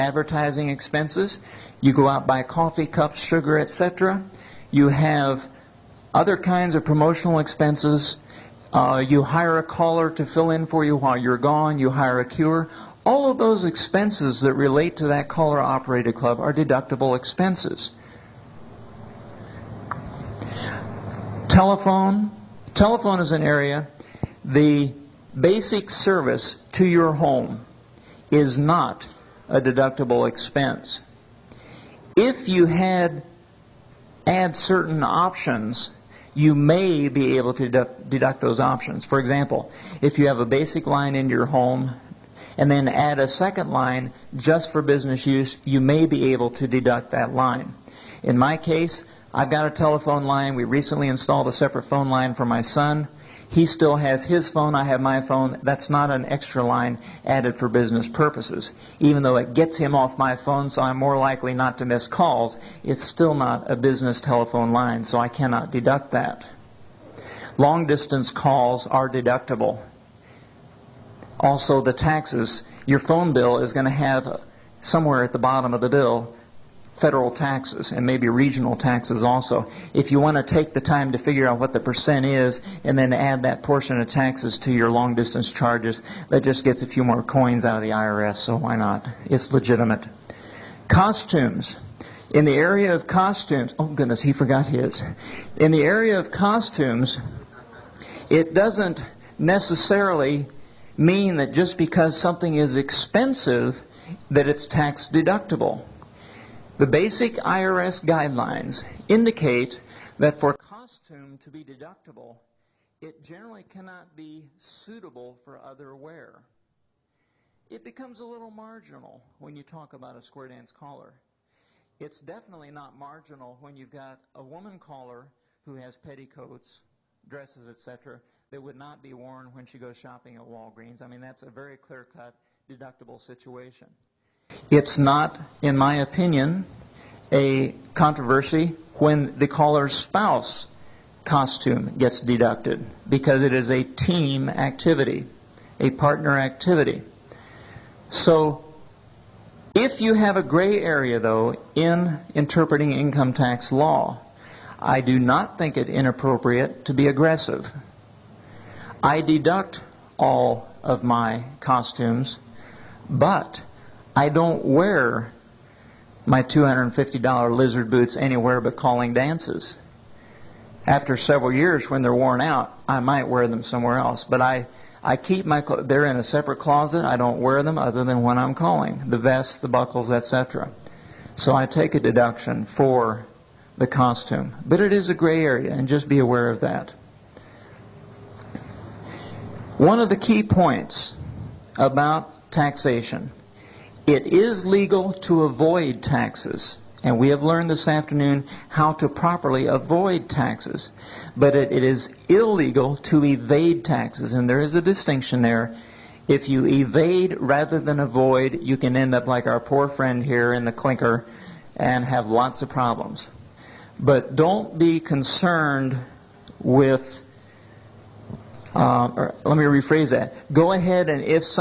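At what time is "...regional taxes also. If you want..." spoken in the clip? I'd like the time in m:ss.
1:18.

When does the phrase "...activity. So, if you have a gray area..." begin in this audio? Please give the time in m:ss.
2:26.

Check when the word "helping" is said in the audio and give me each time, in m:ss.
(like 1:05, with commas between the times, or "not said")
not said.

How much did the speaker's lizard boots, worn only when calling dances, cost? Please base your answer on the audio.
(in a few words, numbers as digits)
$250.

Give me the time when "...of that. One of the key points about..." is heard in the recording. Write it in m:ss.
3:06.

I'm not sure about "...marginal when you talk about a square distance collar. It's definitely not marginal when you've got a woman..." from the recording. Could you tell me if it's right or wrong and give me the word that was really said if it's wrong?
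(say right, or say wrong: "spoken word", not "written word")
wrong: "dance", not "distance".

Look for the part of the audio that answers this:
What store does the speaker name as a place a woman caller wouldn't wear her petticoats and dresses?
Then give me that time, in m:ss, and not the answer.
2:10.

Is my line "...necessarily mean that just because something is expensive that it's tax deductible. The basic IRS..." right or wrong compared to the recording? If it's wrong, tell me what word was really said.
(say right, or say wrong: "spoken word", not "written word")
right.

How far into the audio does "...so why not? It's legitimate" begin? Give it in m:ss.
1:28.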